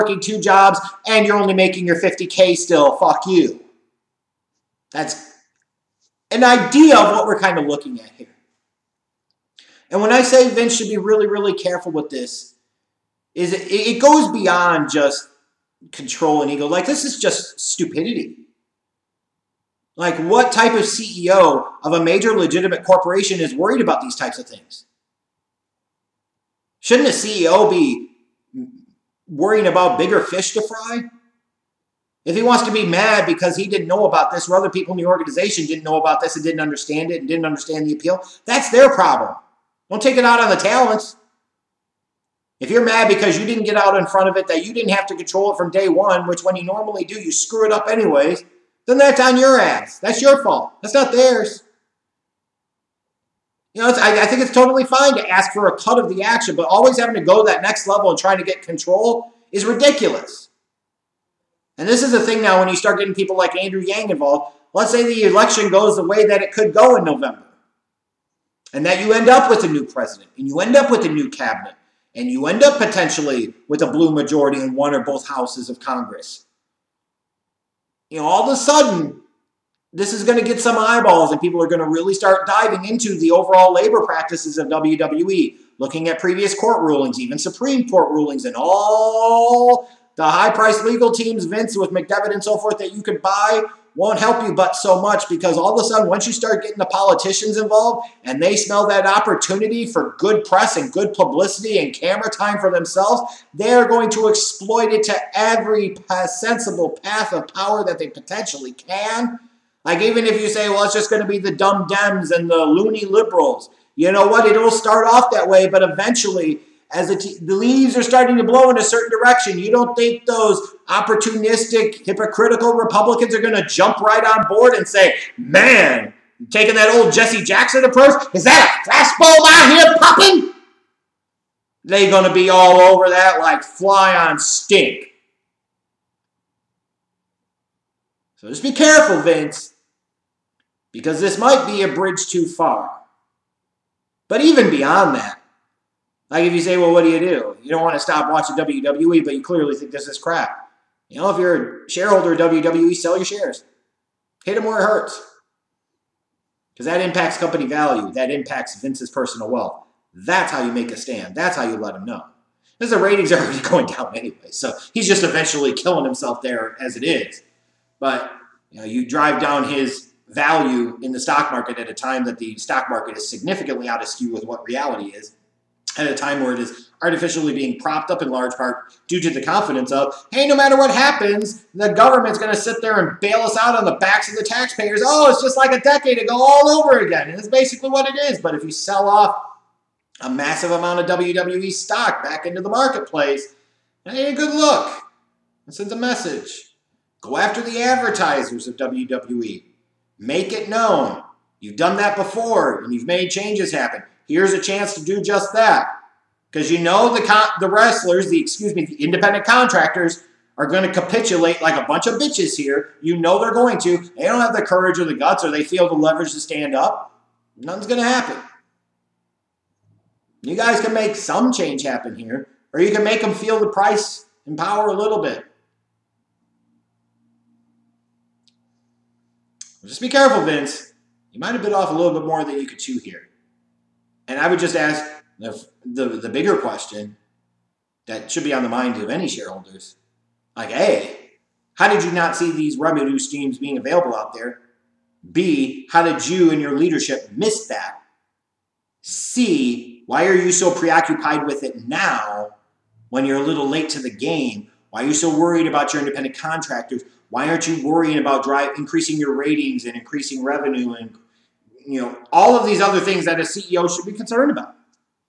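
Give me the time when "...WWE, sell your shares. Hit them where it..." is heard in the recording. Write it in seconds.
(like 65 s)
152 s.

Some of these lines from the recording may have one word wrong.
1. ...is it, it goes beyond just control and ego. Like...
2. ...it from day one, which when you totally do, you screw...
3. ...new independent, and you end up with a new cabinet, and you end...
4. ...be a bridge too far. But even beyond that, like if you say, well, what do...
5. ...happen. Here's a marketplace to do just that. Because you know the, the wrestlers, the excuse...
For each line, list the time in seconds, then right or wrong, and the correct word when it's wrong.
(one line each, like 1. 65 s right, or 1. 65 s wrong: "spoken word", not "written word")
1. 13 s right
2. 45 s wrong: "normally", not "totally"
3. 69 s wrong: "president", not "independent"
4. 141 s right
5. 203 s wrong: "chance", not "marketplace".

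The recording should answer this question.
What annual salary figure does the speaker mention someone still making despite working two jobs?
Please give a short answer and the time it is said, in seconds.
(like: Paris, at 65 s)
50K, at 1 s.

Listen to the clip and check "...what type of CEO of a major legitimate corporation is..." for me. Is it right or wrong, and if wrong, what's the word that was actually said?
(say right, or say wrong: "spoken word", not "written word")
right.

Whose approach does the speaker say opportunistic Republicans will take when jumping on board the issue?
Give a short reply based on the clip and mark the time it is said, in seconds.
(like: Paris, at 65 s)
Jesse Jackson, at 127 s.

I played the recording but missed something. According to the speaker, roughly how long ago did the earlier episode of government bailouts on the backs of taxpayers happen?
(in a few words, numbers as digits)
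a decade ago.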